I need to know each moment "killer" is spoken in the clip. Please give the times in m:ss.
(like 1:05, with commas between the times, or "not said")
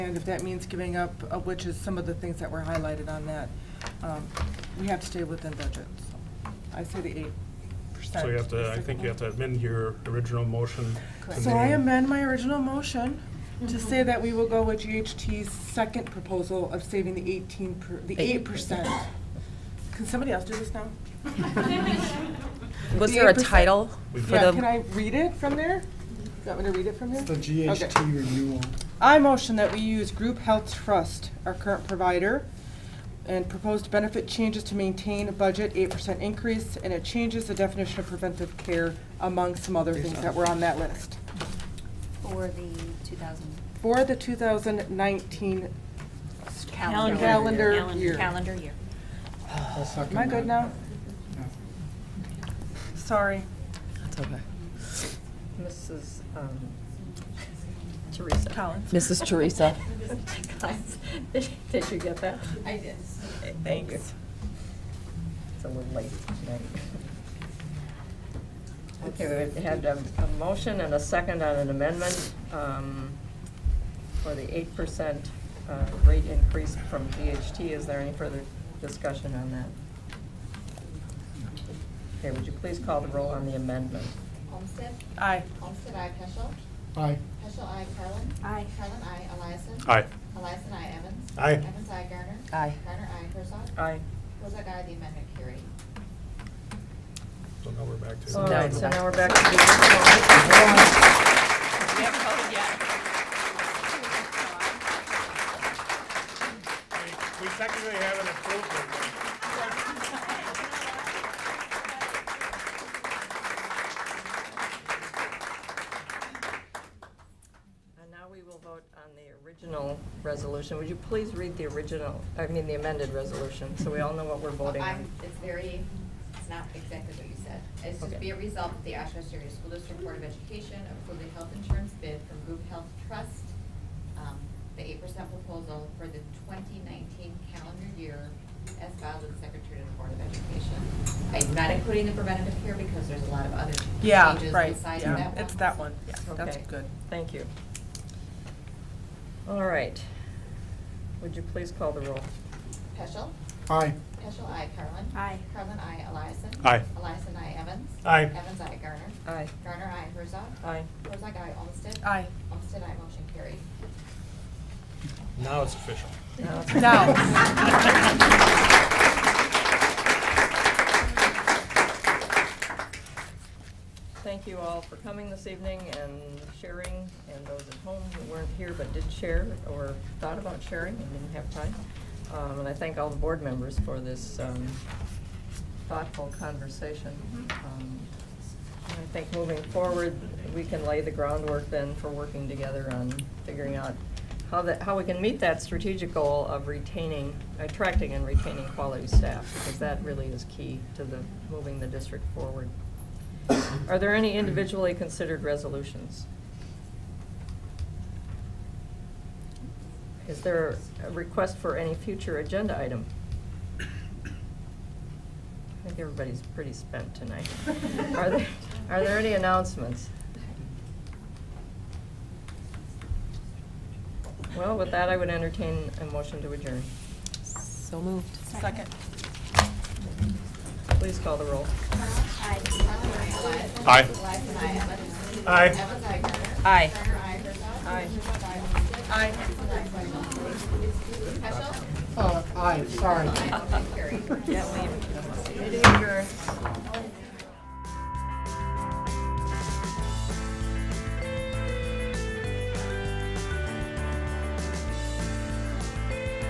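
not said.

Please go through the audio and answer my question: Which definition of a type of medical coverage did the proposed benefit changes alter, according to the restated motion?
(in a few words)
preventive care.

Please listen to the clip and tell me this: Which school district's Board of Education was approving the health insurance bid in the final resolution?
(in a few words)
Oshkosh Area School District.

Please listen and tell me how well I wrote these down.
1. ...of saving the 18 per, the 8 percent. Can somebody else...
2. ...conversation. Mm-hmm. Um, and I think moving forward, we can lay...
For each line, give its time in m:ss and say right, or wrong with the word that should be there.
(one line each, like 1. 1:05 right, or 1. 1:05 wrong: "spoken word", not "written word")
1. 0:16 right
2. 3:06 right.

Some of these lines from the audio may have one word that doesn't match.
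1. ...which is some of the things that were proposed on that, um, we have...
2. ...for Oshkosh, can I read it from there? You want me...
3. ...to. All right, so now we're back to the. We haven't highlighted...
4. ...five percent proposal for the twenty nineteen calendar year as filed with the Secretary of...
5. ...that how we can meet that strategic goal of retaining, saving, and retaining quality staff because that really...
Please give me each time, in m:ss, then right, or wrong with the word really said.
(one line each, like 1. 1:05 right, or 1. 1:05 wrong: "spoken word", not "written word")
1. 0:01 wrong: "highlighted", not "proposed"
2. 0:24 wrong: "Yeah", not "Oshkosh"
3. 1:38 wrong: "voted", not "highlighted"
4. 2:14 wrong: "eight", not "five"
5. 3:14 wrong: "attracting", not "saving".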